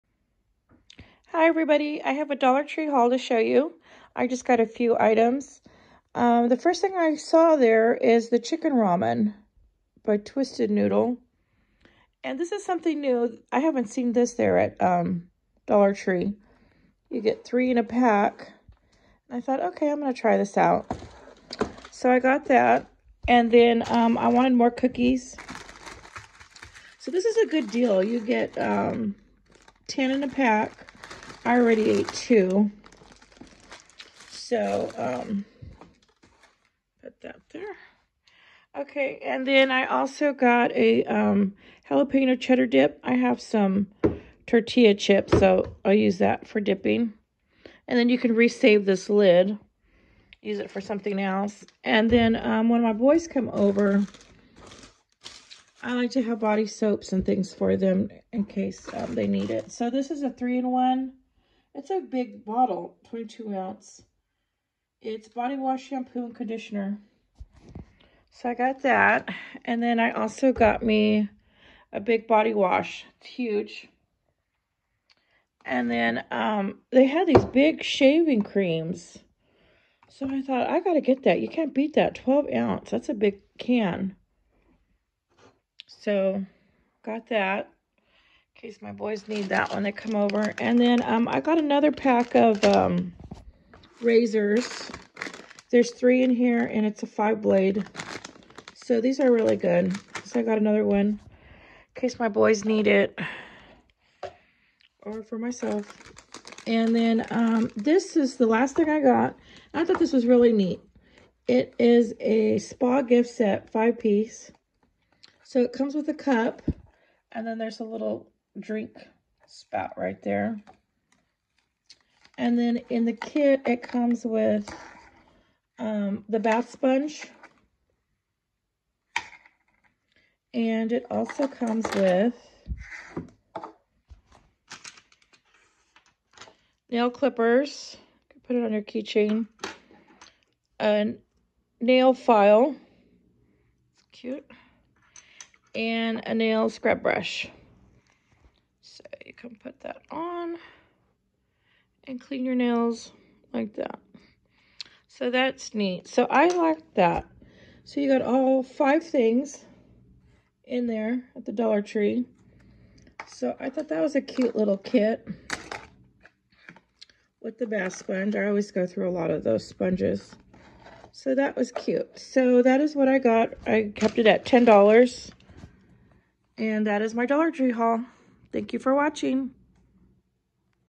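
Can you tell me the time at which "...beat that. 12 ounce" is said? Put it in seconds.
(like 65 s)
81 s.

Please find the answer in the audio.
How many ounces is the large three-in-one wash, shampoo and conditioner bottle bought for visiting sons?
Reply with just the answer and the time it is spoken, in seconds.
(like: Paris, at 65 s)
22, at 63 s.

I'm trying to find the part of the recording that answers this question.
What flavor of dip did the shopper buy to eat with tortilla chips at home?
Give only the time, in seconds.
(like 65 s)
41 s.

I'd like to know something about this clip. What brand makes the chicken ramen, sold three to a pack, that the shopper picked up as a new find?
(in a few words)
Twisted Noodle.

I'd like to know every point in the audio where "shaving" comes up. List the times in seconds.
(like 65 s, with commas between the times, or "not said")
77 s.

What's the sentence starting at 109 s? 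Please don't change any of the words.
I thought this was really neat.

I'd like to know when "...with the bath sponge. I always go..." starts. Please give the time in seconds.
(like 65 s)
167 s.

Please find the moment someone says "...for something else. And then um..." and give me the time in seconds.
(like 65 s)
50 s.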